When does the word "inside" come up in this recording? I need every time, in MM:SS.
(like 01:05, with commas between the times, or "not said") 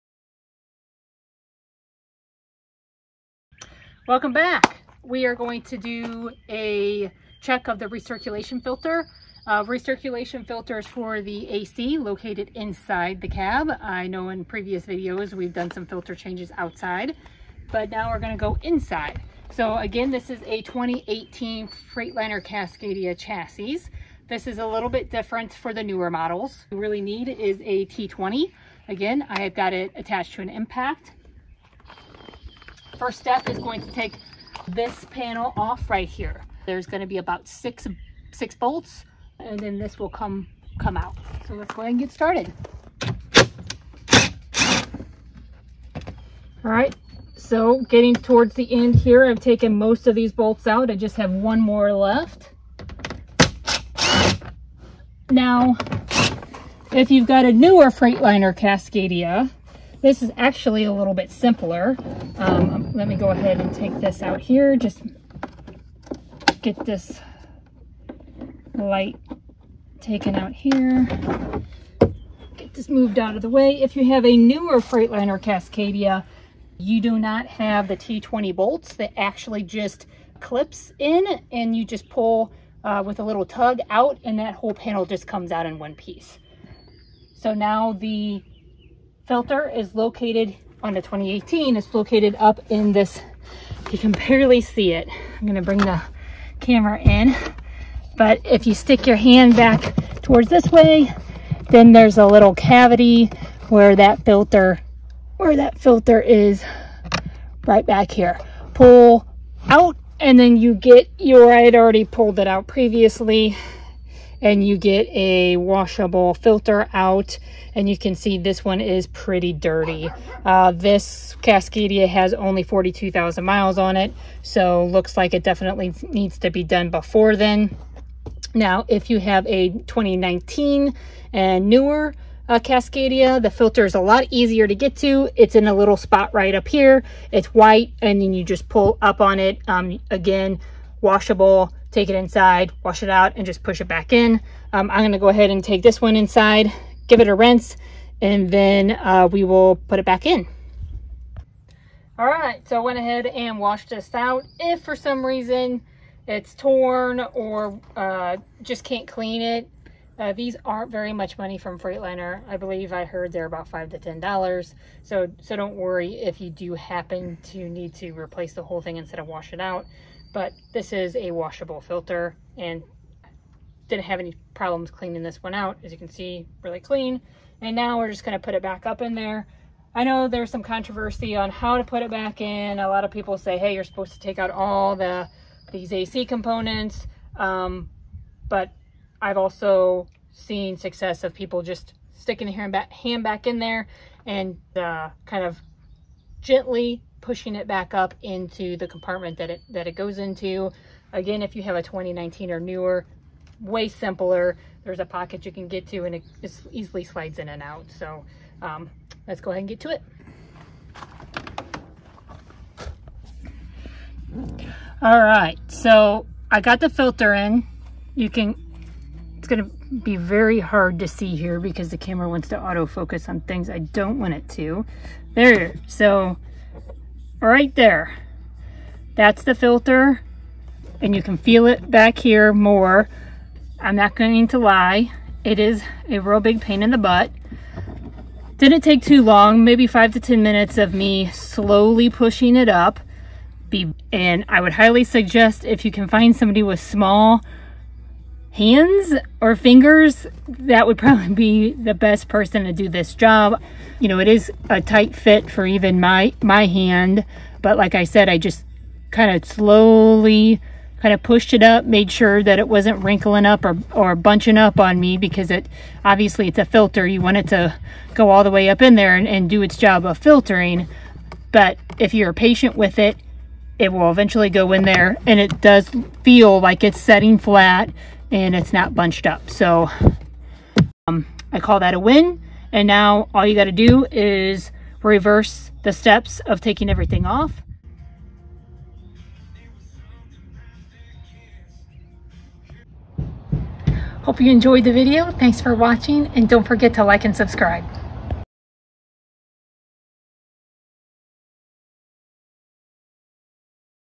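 00:12, 00:18, 02:22, 02:26.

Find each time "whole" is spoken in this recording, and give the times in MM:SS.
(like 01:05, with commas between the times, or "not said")
01:24, 02:48.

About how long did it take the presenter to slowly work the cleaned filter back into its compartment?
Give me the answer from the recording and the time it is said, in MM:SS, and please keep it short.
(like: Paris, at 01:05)
5 to 10 minutes, at 03:59.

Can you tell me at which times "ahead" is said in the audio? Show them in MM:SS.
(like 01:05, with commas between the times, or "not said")
00:41, 01:03, 02:25, 02:32, 03:29.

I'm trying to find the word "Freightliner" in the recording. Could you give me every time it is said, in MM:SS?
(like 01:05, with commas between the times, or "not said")
00:21, 00:57, 01:14, 02:41.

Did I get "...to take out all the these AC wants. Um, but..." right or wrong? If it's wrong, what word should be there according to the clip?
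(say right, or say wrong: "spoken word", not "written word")
wrong: "components", not "wants".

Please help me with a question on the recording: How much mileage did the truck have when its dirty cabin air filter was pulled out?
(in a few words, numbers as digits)
42,000 miles.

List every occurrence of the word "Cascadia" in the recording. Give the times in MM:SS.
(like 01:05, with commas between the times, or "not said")
00:22, 00:58, 01:15, 02:01, 02:12.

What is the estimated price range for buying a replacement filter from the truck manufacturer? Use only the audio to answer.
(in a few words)
$5 to $10.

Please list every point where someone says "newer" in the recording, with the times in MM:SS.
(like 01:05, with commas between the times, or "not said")
00:25, 00:57, 01:14, 02:11, 03:22.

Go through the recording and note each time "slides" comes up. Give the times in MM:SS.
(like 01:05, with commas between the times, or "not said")
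03:27.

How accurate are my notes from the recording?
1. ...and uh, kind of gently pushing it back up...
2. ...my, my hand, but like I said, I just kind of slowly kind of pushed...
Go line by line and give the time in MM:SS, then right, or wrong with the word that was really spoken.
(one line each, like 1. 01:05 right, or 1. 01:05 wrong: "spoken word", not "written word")
1. 03:14 right
2. 04:15 right.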